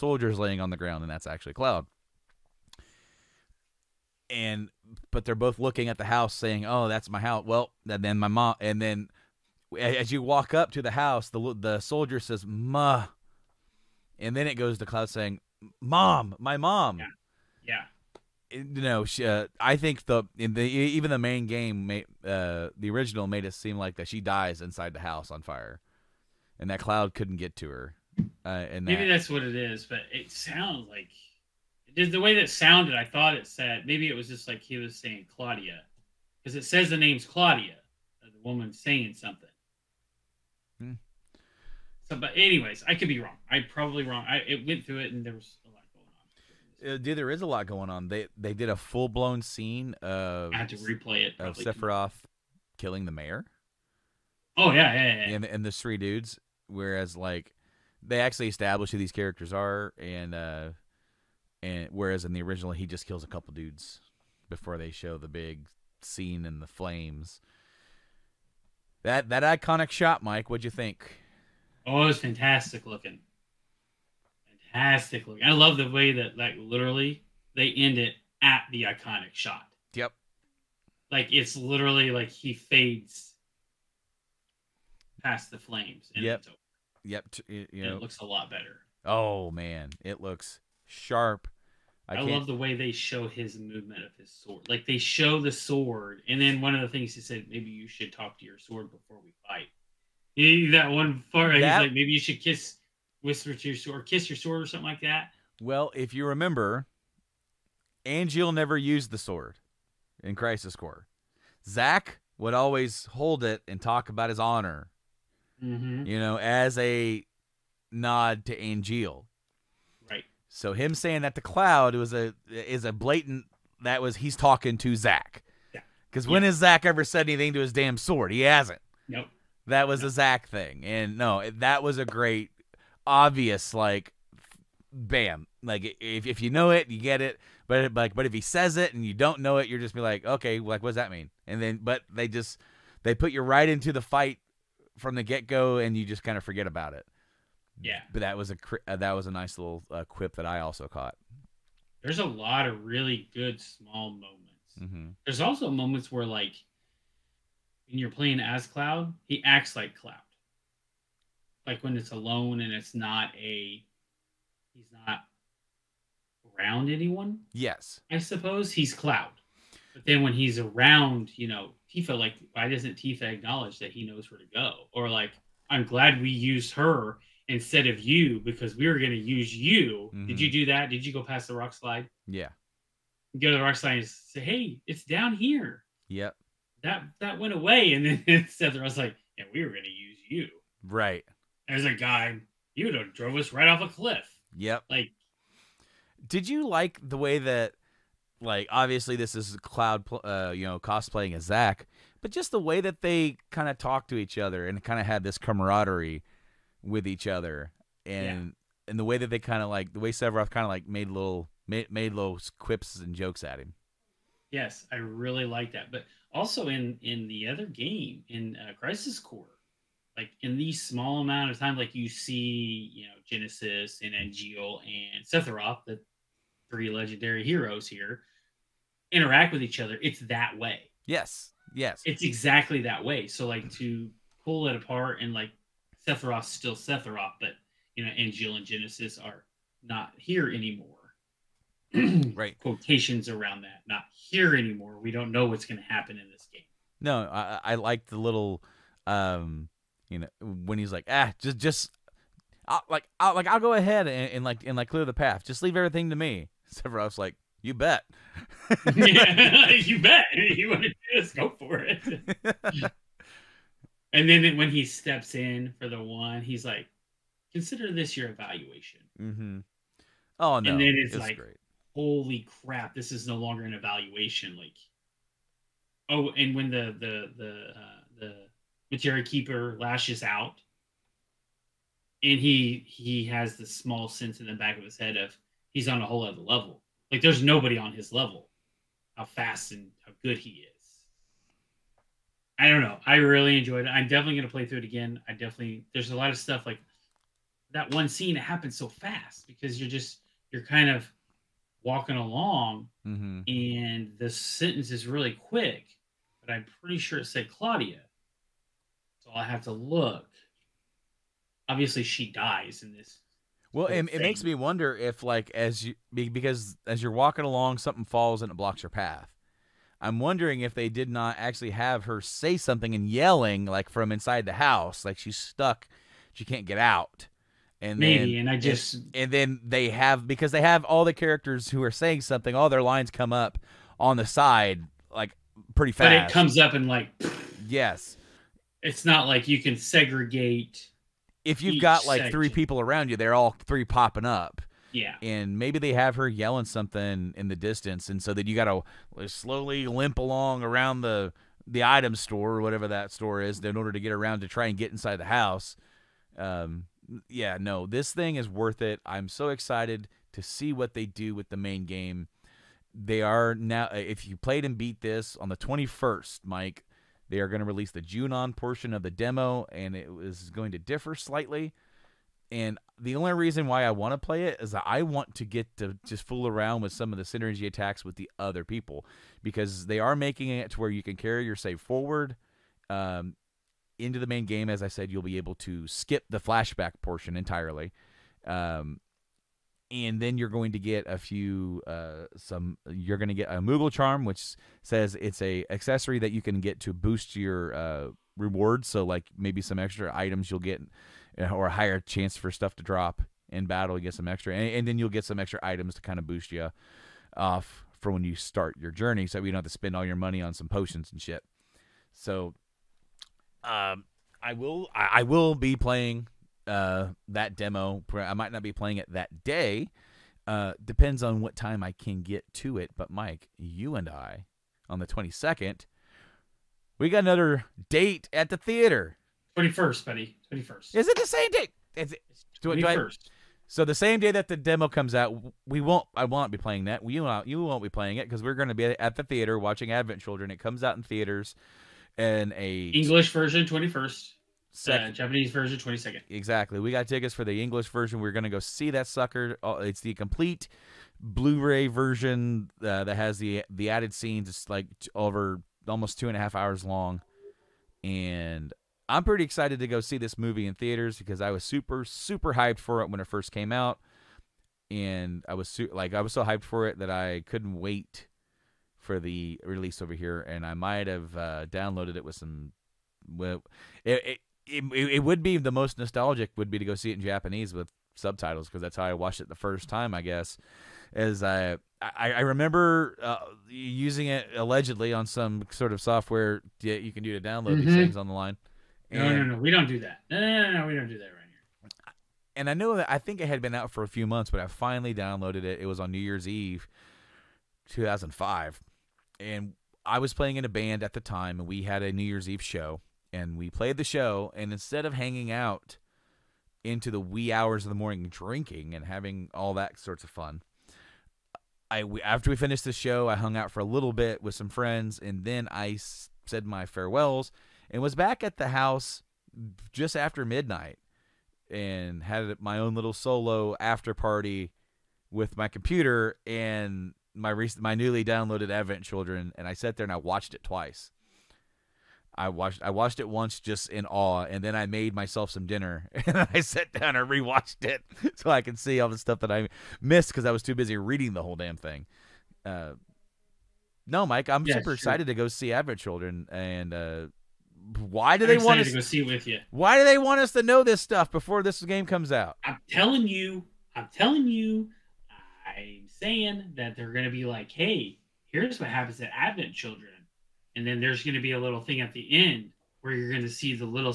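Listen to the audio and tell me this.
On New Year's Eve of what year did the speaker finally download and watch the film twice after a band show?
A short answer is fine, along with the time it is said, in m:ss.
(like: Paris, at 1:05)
2005, at 8:17.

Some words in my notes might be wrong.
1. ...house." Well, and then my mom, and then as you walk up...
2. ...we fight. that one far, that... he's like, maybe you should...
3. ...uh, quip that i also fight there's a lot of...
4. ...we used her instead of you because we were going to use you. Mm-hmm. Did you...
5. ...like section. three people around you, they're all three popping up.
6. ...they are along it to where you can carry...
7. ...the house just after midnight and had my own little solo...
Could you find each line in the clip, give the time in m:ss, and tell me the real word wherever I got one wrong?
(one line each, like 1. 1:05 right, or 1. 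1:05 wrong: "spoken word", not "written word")
1. 0:07 right
2. 1:39 right
3. 2:29 wrong: "caught", not "fight"
4. 2:56 right
5. 5:42 right
6. 6:19 wrong: "making", not "along"
7. 8:38 right.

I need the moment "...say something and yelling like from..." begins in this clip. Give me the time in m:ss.
5:22.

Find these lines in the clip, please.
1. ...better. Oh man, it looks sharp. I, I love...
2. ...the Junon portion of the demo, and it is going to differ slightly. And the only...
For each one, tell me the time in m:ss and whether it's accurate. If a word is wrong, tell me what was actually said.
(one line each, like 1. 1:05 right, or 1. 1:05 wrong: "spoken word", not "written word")
1. 1:28 right
2. 6:07 right.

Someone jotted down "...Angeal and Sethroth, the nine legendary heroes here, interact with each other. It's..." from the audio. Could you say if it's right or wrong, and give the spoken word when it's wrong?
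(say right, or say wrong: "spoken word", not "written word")
wrong: "three", not "nine".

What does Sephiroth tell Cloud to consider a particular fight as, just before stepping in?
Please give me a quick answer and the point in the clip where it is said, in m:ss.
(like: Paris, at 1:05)
your evaluation, at 4:27.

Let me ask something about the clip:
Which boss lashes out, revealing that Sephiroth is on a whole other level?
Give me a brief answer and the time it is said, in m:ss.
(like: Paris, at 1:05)
the Materia Keeper, at 4:38.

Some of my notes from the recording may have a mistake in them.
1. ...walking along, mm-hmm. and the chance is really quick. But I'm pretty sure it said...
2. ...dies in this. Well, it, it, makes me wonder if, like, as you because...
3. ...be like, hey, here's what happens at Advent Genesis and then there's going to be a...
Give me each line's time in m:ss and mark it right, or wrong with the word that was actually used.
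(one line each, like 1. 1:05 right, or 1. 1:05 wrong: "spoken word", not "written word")
1. 5:01 wrong: "sentence", not "chance"
2. 5:12 right
3. 9:17 wrong: "Children", not "Genesis".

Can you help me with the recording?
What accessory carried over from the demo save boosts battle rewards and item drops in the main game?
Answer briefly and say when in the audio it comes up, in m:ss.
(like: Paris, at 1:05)
moogle charm, at 6:33.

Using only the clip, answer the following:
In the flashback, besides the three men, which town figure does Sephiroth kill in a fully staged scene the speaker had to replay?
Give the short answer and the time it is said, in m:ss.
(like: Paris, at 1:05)
the mayor, at 0:53.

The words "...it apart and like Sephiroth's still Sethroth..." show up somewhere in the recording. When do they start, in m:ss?
3:54.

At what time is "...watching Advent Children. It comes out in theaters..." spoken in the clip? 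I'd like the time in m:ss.
7:19.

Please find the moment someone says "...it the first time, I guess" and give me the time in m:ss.
7:59.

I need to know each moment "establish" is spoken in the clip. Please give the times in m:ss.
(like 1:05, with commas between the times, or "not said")
0:58.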